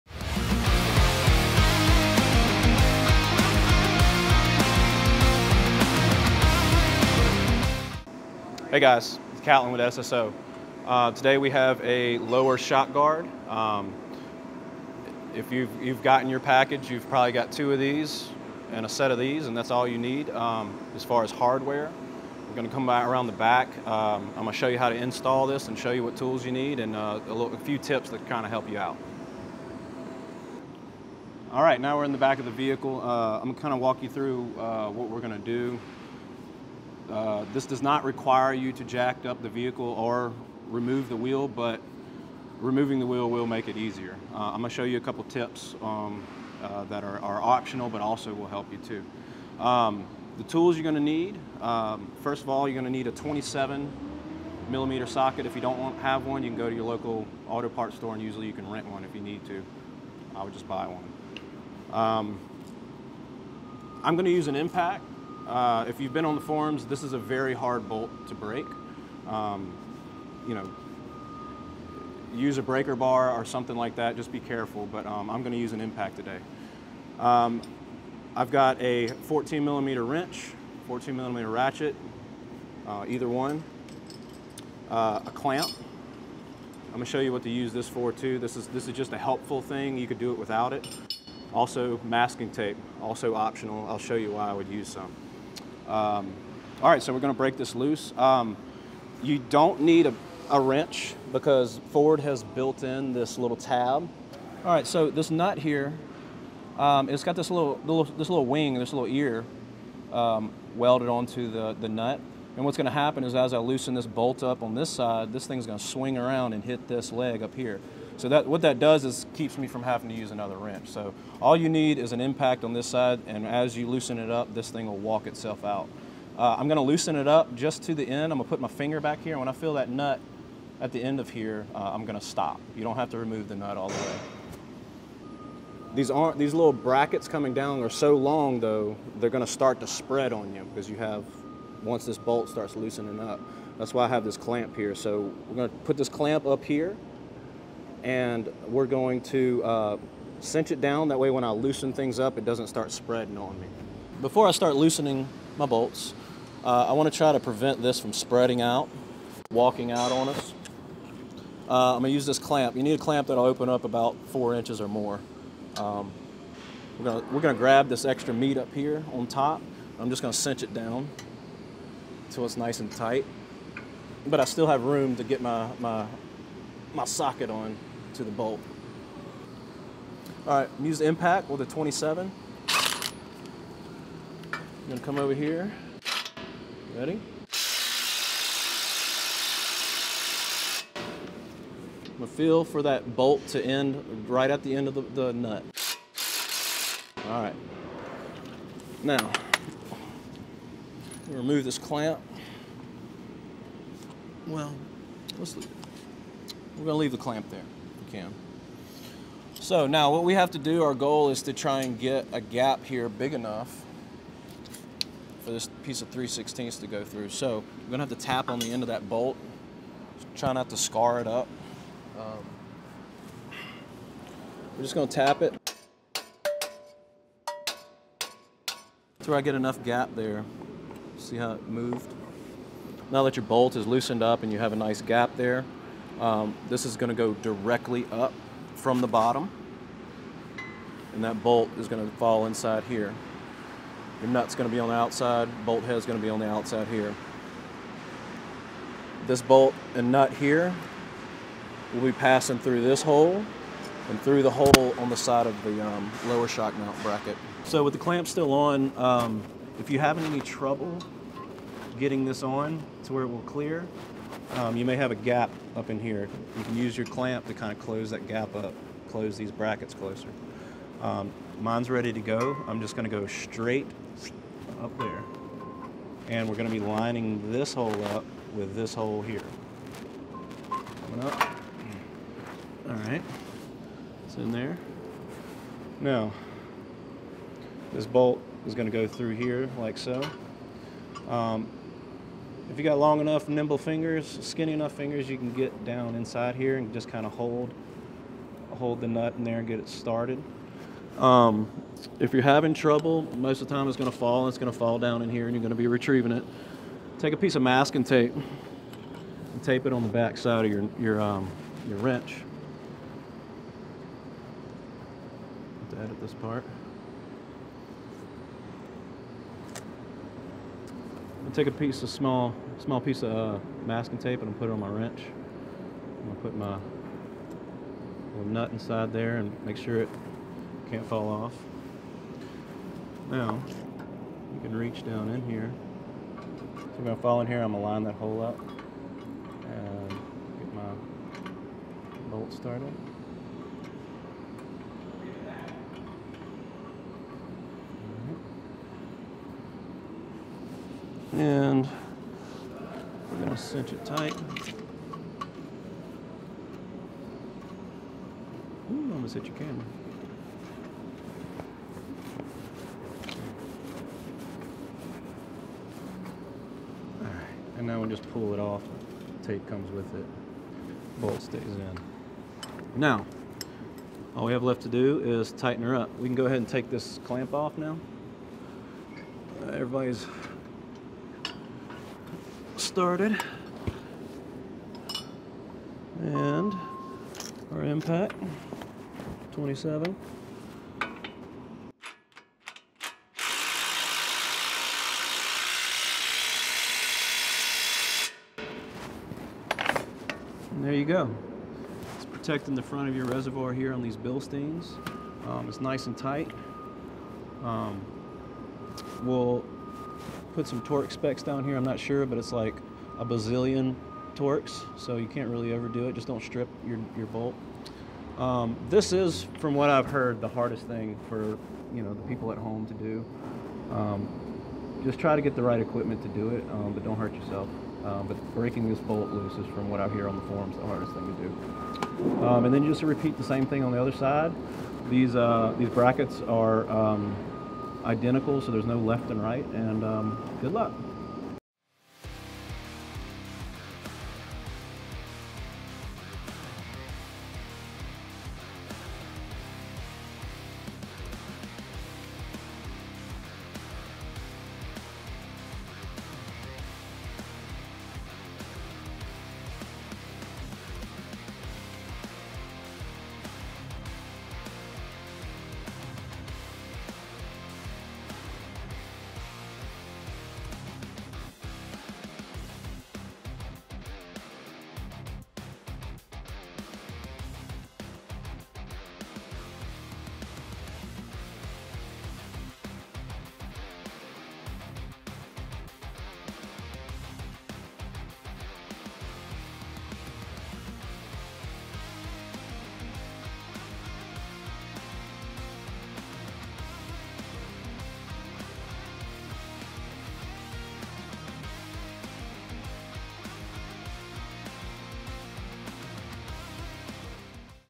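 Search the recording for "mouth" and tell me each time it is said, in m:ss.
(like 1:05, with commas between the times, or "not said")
not said.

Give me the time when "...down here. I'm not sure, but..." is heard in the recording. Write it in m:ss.
6:51.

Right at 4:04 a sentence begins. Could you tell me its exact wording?
Your nut's going to be on the outside, bolt head's going to be on the outside here.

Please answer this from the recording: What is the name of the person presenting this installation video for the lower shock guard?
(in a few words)
Catlin.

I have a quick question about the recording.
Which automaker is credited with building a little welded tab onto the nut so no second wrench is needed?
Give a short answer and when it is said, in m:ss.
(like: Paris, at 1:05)
Ford, at 1:41.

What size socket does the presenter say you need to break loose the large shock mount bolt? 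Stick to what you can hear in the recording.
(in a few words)
27 millimeter.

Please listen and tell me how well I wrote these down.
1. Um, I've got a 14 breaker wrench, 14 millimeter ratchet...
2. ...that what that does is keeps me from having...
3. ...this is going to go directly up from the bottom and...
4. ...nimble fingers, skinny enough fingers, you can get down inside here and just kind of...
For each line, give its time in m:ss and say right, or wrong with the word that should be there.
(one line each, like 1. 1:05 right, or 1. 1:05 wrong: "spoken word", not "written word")
1. 1:17 wrong: "millimeter", not "breaker"
2. 1:58 right
3. 3:56 right
4. 4:53 right.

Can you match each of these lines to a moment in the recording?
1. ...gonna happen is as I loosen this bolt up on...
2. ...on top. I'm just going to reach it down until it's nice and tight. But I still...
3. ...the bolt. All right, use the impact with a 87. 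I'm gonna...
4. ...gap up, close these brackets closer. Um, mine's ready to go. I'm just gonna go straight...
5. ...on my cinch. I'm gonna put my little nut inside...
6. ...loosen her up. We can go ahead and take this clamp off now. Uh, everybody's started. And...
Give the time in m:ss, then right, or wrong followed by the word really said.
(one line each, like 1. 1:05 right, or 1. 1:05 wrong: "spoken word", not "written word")
1. 1:52 right
2. 2:49 wrong: "cinch", not "reach"
3. 2:58 wrong: "27", not "87"
4. 4:28 right
5. 5:24 wrong: "wrench", not "cinch"
6. 6:15 wrong: "tighten", not "loosen".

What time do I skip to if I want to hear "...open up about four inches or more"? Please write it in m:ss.
2:43.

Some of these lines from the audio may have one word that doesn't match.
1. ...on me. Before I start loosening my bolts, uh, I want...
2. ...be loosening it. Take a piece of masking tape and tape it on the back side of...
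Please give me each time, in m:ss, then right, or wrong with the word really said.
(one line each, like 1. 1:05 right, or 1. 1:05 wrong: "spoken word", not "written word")
1. 2:33 right
2. 5:05 wrong: "retrieving", not "loosening".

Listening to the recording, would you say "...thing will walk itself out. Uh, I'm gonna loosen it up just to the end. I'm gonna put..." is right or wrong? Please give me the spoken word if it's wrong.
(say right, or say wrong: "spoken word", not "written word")
right.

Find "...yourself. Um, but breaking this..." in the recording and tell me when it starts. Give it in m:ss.
7:07.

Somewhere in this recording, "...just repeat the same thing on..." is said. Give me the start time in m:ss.
7:12.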